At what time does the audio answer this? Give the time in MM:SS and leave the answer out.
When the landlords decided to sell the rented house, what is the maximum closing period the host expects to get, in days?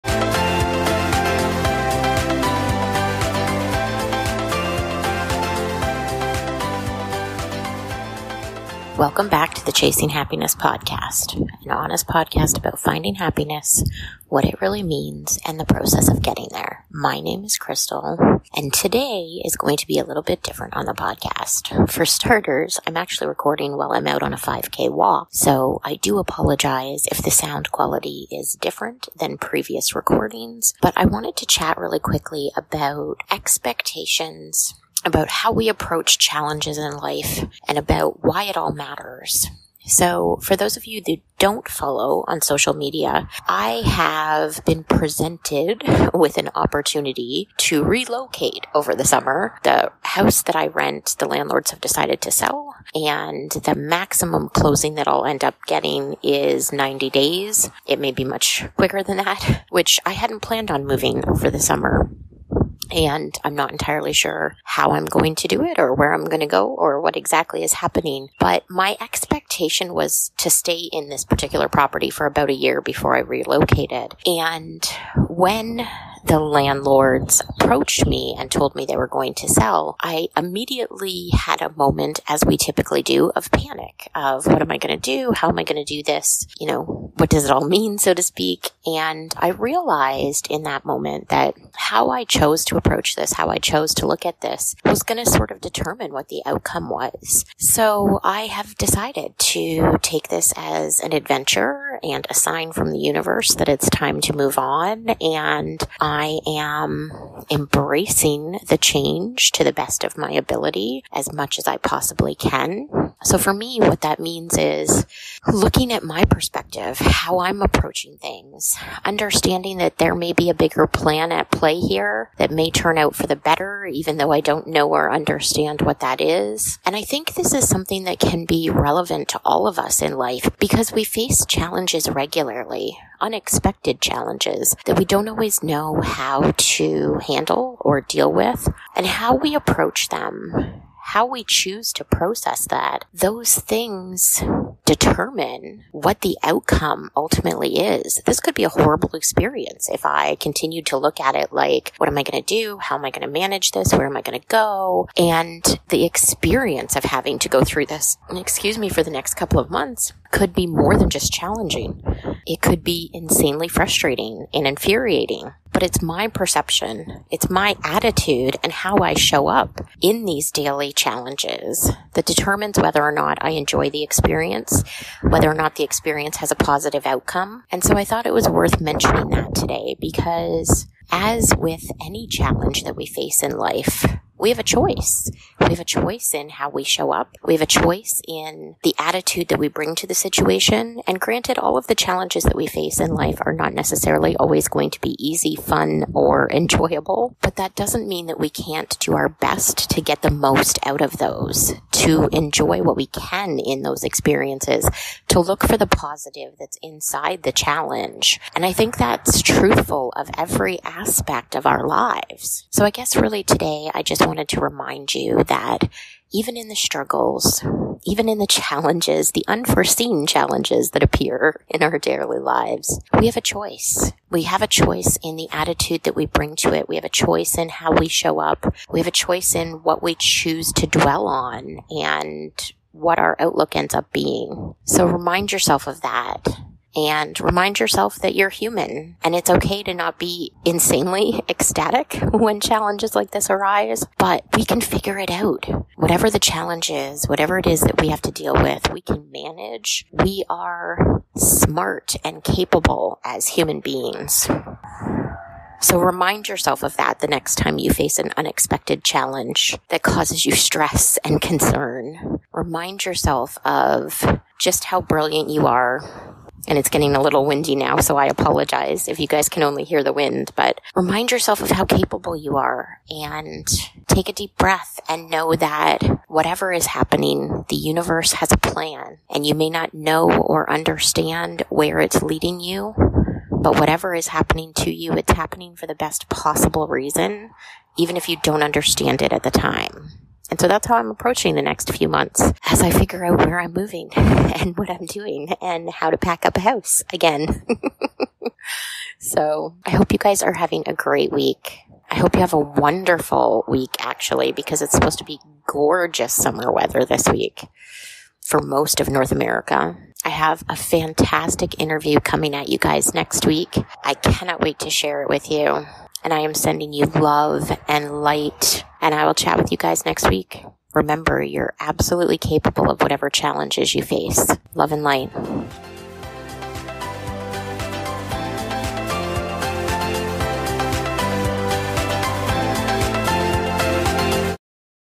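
00:56.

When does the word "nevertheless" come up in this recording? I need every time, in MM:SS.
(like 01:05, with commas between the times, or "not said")
not said.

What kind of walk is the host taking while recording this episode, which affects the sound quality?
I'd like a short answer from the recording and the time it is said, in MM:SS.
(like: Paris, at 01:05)
5K, at 00:24.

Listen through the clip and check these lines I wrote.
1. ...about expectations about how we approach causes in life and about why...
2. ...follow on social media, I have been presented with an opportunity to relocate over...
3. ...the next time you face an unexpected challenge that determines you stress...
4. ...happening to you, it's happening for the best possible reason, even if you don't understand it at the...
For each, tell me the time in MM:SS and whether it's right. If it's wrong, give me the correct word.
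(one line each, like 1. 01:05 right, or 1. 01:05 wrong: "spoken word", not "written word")
1. 00:32 wrong: "challenges", not "causes"
2. 00:41 right
3. 04:17 wrong: "causes", not "determines"
4. 04:44 right.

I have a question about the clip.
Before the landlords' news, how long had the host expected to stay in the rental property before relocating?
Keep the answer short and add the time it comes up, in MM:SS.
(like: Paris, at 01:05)
a year, at 01:12.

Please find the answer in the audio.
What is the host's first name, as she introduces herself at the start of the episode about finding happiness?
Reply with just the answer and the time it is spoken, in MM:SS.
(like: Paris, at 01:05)
Crystal, at 00:17.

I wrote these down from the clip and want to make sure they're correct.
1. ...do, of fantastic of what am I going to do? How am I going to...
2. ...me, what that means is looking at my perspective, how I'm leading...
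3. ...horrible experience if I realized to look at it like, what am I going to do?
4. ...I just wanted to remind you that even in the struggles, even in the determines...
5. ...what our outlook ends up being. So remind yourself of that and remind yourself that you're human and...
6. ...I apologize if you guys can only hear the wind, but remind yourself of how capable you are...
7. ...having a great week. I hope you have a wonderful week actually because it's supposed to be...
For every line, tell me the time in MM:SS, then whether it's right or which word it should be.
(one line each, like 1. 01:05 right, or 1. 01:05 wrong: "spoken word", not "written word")
1. 01:23 wrong: "panic", not "fantastic"
2. 01:53 wrong: "approaching", not "leading"
3. 02:28 wrong: "continued", not "realized"
4. 03:33 wrong: "challenges", not "determines"
5. 03:52 right
6. 04:28 right
7. 05:00 right.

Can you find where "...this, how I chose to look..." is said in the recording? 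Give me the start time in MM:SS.
01:33.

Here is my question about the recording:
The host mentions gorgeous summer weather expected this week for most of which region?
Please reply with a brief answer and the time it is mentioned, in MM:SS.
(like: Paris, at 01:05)
North America, at 05:09.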